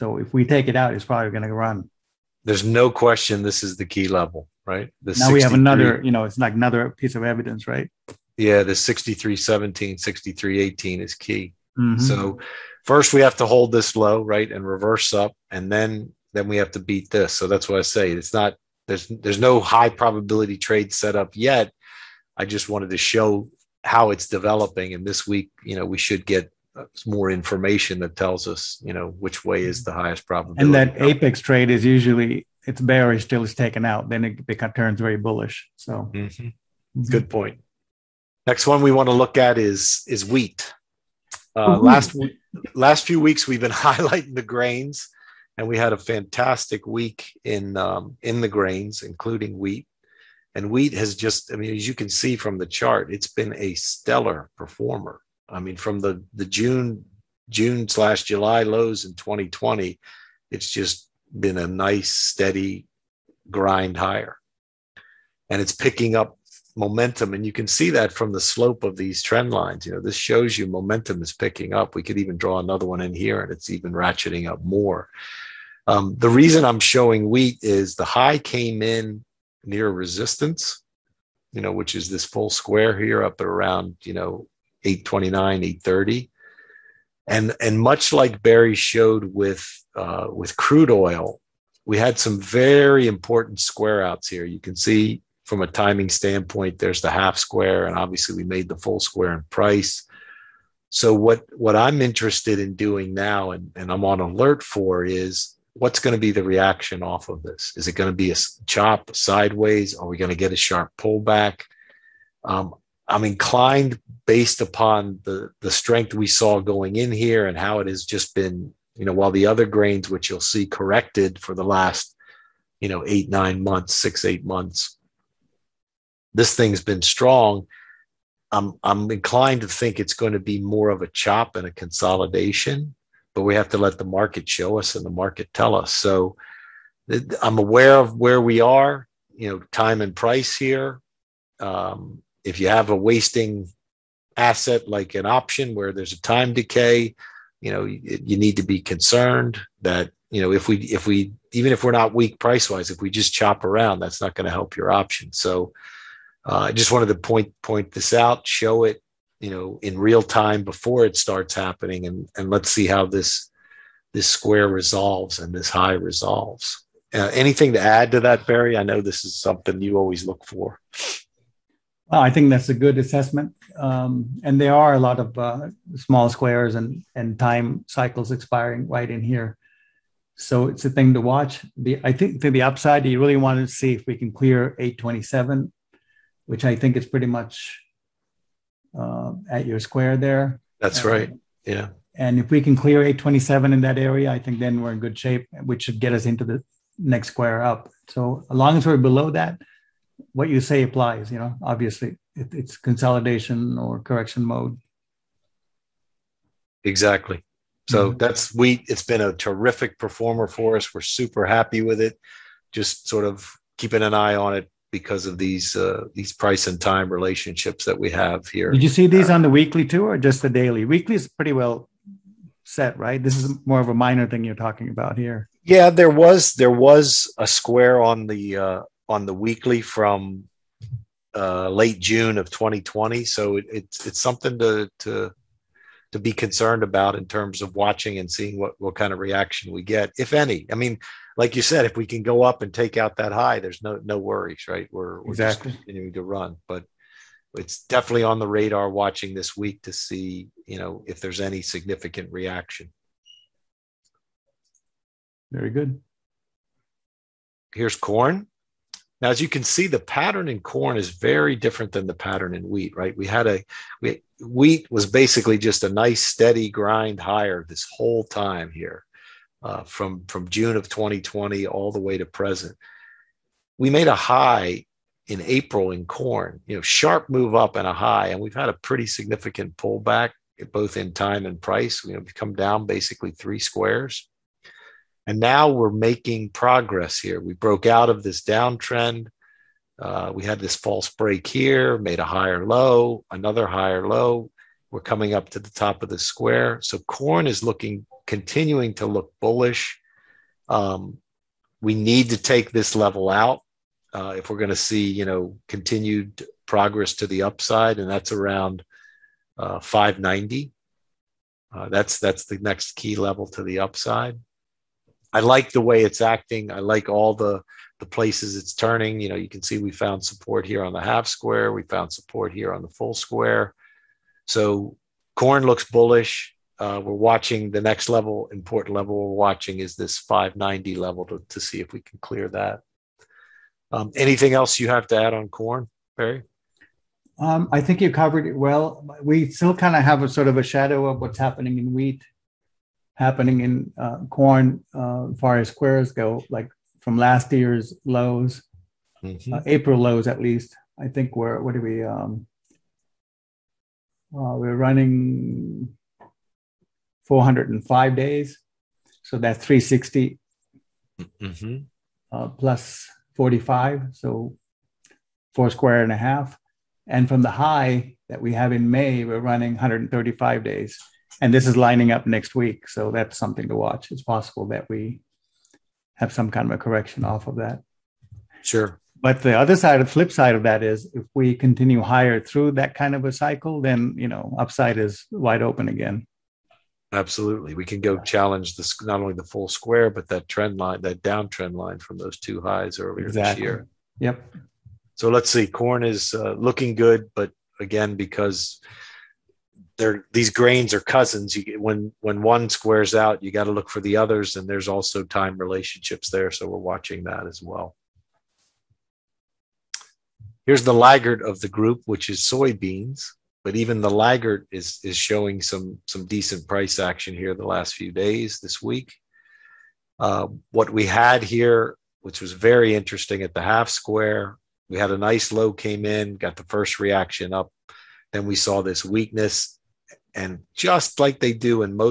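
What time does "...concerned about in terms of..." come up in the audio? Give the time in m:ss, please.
3:56.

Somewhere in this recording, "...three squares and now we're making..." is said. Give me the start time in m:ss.
4:43.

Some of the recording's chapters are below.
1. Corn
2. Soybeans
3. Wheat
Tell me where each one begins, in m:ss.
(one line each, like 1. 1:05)
1. 4:14
2. 6:48
3. 0:37.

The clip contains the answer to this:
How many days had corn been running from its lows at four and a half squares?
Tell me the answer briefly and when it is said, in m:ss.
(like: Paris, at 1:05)
405, at 5:57.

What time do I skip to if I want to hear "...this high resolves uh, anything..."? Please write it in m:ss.
2:45.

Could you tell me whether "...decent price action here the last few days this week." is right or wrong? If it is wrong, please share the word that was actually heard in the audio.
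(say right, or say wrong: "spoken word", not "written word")
right.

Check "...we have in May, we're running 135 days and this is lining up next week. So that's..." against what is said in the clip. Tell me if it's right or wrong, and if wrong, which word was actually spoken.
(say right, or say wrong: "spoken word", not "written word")
right.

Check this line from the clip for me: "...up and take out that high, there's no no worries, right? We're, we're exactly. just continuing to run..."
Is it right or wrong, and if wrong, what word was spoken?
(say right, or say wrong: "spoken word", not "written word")
right.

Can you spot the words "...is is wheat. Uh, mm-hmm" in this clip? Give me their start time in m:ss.
0:39.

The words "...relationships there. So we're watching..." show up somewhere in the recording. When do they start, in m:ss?
6:45.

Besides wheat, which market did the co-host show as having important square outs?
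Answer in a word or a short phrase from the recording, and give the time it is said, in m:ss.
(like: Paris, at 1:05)
Crude oil, at 1:30.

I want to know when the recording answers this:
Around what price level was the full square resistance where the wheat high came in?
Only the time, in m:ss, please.
1:25.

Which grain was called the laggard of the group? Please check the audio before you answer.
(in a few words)
Soybeans.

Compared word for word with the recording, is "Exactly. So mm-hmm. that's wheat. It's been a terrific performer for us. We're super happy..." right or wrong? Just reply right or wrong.
right.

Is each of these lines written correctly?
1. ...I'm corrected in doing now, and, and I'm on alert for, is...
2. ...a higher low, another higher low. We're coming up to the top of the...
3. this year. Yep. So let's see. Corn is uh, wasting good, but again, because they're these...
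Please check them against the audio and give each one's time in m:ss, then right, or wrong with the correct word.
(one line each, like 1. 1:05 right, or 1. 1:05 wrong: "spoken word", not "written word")
1. 1:41 wrong: "interested", not "corrected"
2. 4:52 right
3. 6:33 wrong: "looking", not "wasting".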